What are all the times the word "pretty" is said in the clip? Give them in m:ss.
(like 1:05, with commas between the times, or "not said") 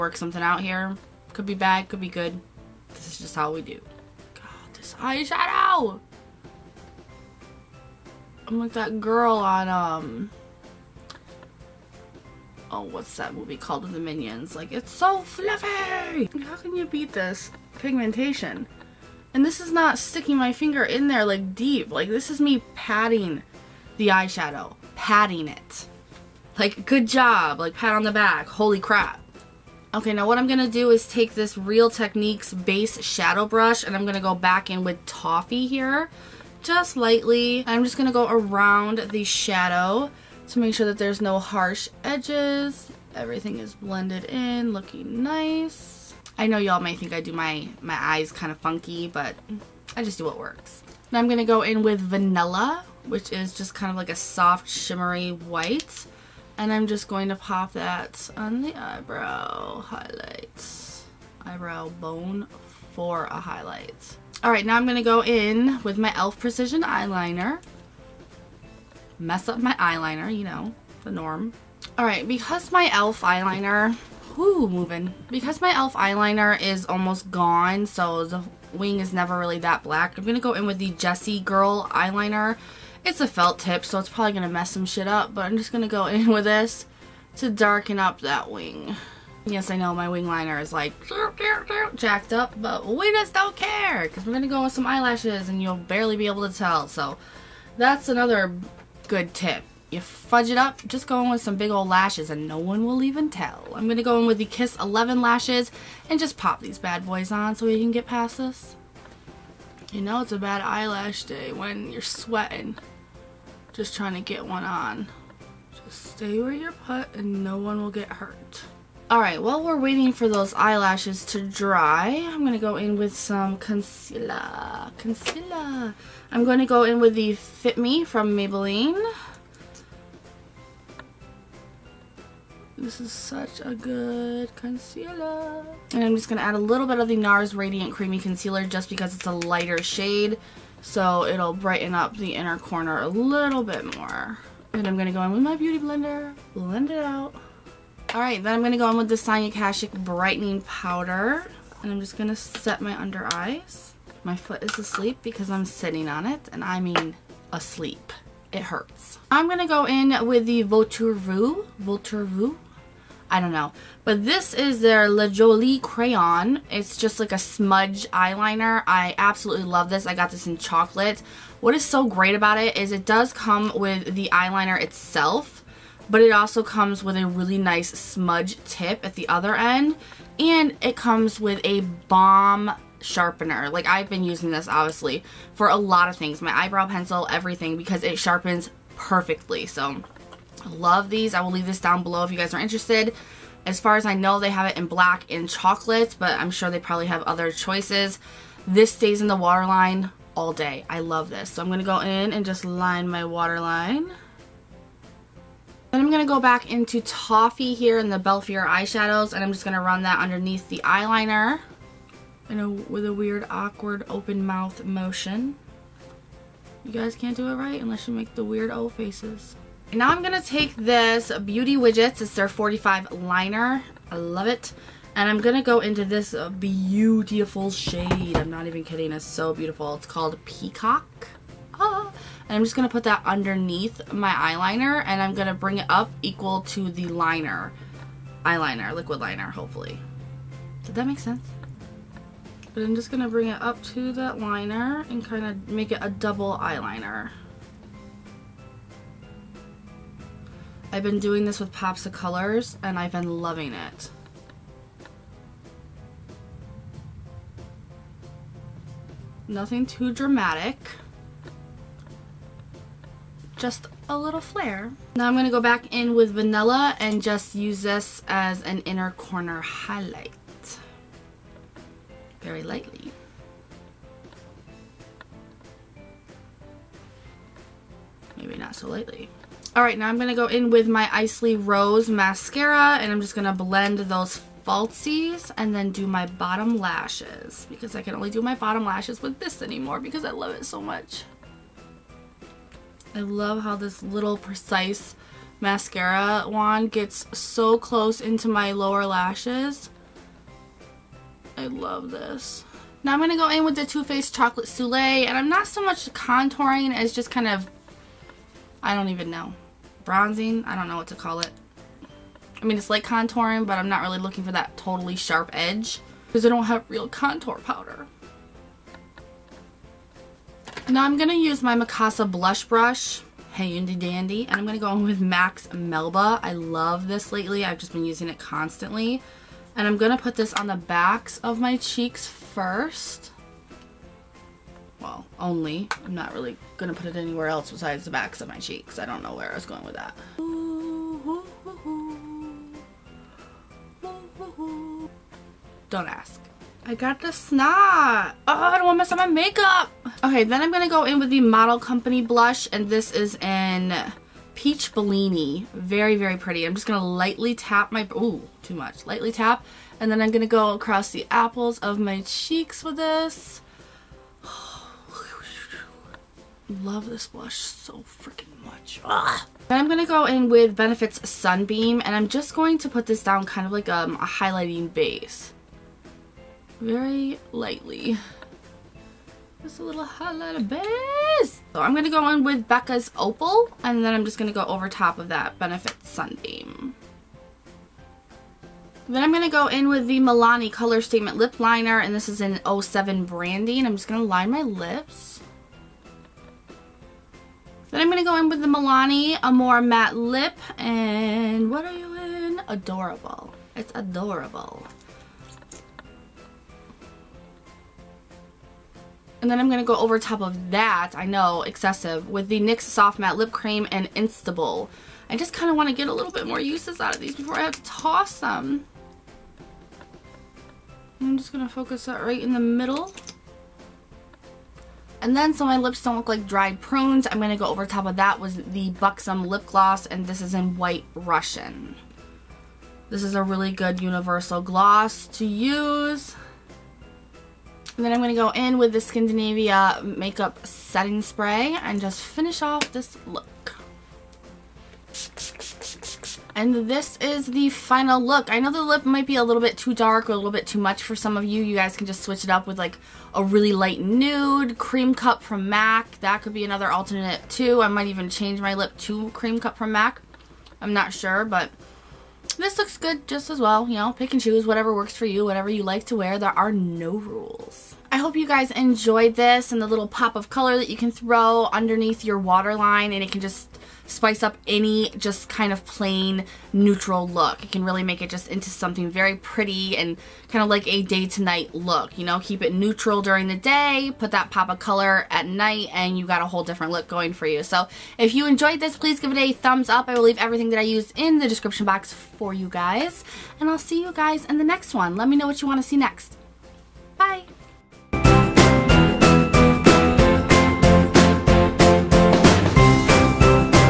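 5:56, 7:59.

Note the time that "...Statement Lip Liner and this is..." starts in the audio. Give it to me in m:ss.
6:31.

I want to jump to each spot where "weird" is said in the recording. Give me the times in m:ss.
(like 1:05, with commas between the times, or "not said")
3:33, 3:38.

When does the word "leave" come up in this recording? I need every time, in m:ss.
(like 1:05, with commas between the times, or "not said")
3:11, 8:10.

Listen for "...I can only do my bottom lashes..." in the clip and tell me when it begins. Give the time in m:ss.
4:47.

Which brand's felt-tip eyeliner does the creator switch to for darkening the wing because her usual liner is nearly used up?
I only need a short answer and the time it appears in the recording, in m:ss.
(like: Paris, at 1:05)
Jessie Girl, at 1:20.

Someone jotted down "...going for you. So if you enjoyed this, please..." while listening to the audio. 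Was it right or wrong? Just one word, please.
right.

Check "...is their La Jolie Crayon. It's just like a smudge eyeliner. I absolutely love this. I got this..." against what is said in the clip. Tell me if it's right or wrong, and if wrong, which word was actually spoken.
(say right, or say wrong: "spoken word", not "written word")
right.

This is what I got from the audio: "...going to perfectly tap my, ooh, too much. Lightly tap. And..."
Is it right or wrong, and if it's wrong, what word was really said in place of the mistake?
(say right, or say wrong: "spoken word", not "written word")
wrong: "lightly", not "perfectly".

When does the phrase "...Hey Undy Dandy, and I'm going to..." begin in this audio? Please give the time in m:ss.
5:23.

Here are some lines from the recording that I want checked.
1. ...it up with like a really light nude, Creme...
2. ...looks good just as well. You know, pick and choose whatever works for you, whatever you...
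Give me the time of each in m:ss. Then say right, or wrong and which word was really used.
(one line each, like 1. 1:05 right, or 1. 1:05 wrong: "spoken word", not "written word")
1. 7:32 right
2. 7:42 right.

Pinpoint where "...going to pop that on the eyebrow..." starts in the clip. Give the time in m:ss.
0:57.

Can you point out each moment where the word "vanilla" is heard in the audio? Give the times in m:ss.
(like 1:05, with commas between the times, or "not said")
0:52, 4:26.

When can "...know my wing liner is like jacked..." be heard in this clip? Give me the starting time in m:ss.
1:29.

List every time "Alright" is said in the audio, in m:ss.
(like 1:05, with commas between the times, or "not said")
1:04, 1:59, 2:28, 4:39.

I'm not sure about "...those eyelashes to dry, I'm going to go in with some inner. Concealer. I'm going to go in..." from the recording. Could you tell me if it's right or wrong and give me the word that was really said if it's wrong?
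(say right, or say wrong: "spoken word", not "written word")
wrong: "concealer", not "inner".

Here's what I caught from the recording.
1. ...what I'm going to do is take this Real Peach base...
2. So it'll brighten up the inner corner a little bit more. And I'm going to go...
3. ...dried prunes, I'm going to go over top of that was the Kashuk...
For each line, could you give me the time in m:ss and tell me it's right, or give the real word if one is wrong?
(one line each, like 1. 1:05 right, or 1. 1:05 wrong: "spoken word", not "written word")
1. 0:30 wrong: "Techniques", not "Peach"
2. 2:20 right
3. 7:06 wrong: "Buxom", not "Kashuk".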